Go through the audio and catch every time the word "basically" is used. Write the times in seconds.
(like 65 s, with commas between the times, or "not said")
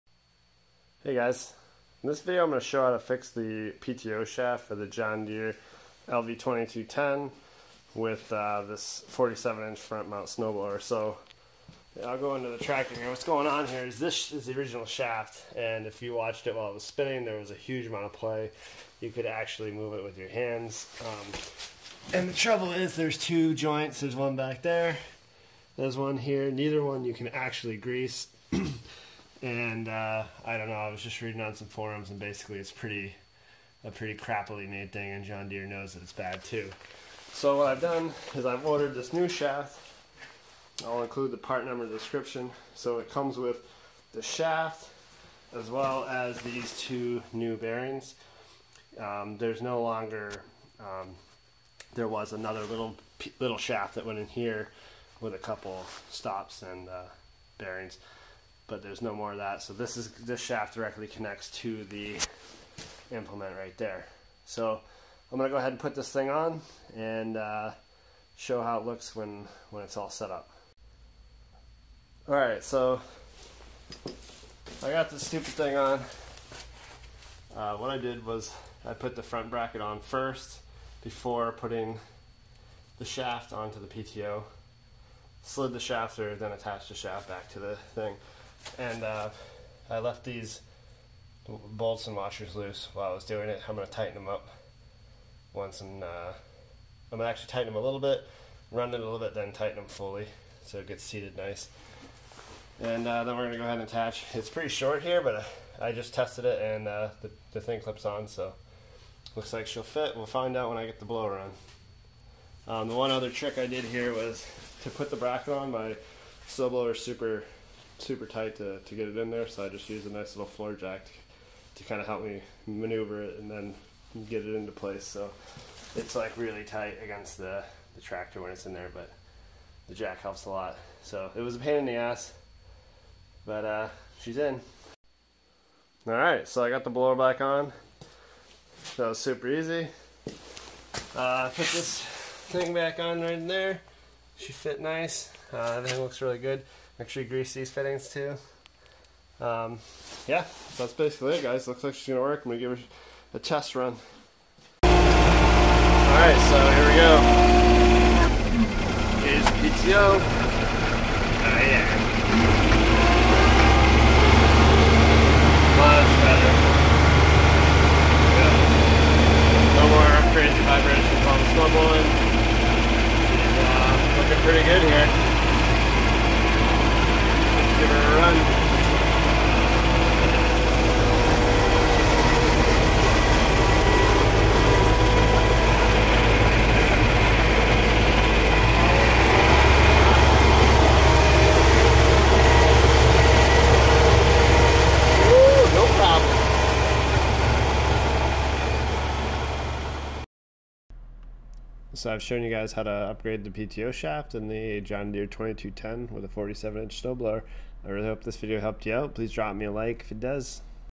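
32 s, 150 s.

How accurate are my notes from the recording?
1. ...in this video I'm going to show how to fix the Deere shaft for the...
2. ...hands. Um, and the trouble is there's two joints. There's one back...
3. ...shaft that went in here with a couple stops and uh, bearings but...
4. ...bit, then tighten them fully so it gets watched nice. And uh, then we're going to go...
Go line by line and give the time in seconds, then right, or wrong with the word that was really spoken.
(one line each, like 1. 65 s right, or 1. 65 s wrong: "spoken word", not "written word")
1. 2 s wrong: "PTO", not "Deere"
2. 20 s right
3. 53 s right
4. 99 s wrong: "seated", not "watched".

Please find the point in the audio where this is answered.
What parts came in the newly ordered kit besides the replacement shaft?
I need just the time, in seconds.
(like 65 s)
46 s.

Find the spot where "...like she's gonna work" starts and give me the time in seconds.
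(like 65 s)
151 s.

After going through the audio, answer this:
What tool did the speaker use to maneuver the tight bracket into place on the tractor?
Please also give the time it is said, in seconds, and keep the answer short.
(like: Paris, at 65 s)
floor jack, at 120 s.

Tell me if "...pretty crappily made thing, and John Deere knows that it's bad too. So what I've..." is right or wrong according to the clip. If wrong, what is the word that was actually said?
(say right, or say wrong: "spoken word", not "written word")
right.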